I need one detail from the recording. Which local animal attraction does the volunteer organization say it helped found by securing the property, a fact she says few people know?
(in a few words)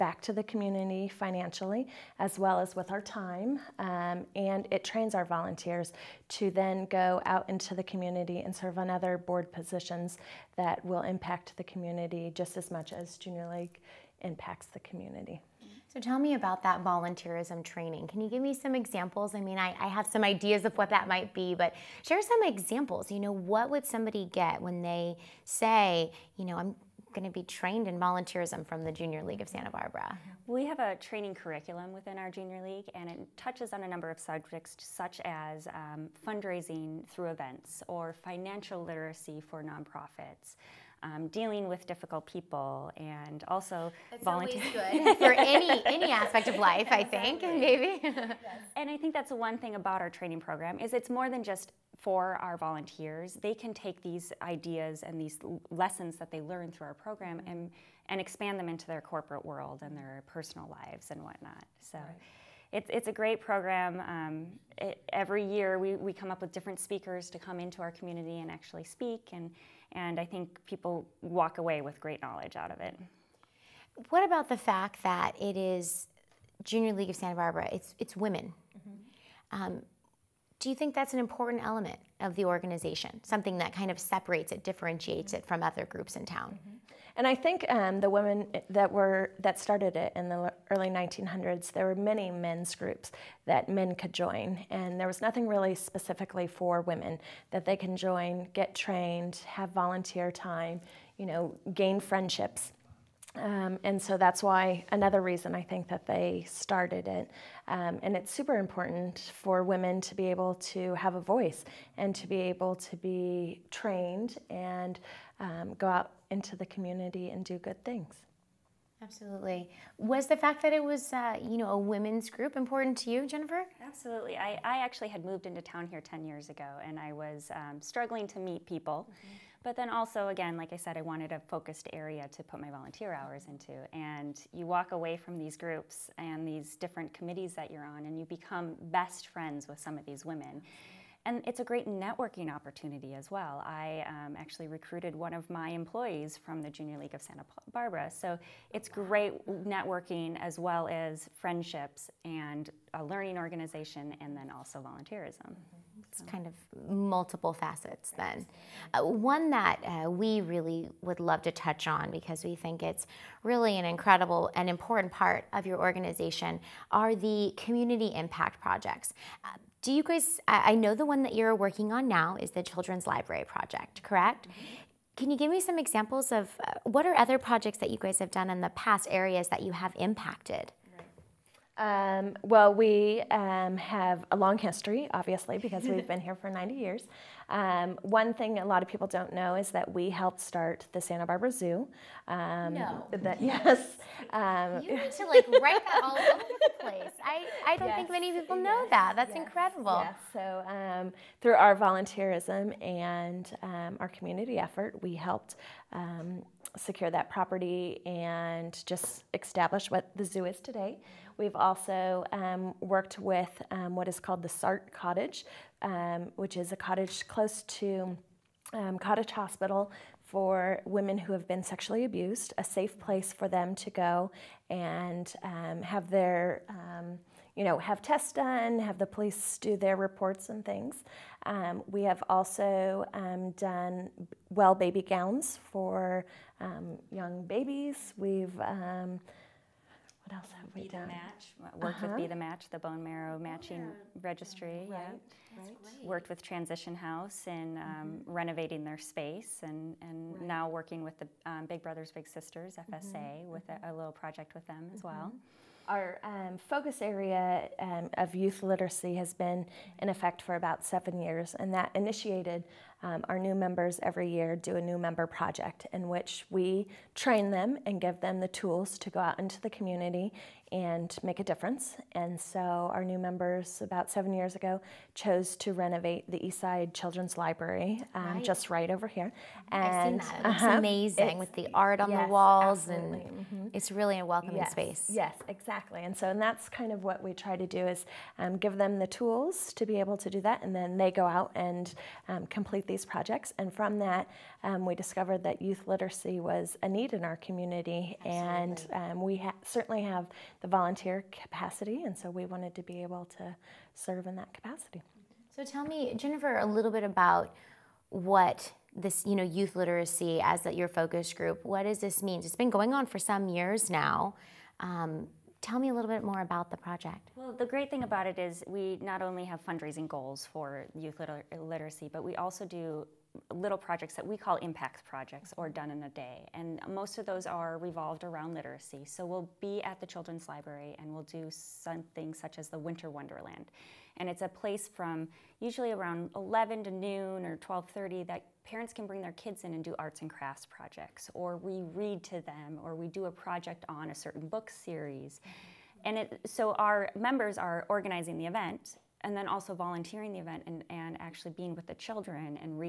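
Santa Barbara Zoo.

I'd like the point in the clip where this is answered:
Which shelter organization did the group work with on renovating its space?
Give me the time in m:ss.
4:06.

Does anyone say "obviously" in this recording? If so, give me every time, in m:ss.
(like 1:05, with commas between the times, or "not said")
3:05.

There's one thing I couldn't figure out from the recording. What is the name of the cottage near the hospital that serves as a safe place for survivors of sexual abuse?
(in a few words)
SART Cottage.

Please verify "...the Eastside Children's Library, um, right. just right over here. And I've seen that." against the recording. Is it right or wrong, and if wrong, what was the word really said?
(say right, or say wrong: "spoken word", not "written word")
right.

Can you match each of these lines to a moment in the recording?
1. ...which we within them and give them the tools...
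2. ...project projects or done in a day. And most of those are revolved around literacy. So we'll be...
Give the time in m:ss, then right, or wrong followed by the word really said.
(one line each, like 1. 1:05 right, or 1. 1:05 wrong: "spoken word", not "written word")
1. 4:26 wrong: "train", not "within"
2. 5:24 wrong: "impact", not "project".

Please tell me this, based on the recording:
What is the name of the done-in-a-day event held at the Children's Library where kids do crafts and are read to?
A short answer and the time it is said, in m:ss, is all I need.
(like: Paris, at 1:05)
Winter Wonderland, at 5:32.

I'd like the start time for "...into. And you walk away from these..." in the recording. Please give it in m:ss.
2:13.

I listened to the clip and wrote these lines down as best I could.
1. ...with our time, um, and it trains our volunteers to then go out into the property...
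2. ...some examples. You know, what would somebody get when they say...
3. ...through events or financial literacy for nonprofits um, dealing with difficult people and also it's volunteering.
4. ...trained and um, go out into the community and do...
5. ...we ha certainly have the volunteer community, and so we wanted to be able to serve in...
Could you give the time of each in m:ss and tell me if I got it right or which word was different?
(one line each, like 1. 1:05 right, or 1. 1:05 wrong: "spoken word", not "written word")
1. 0:02 wrong: "community", not "property"
2. 0:22 right
3. 0:37 right
4. 1:53 right
5. 4:59 wrong: "capacity", not "community".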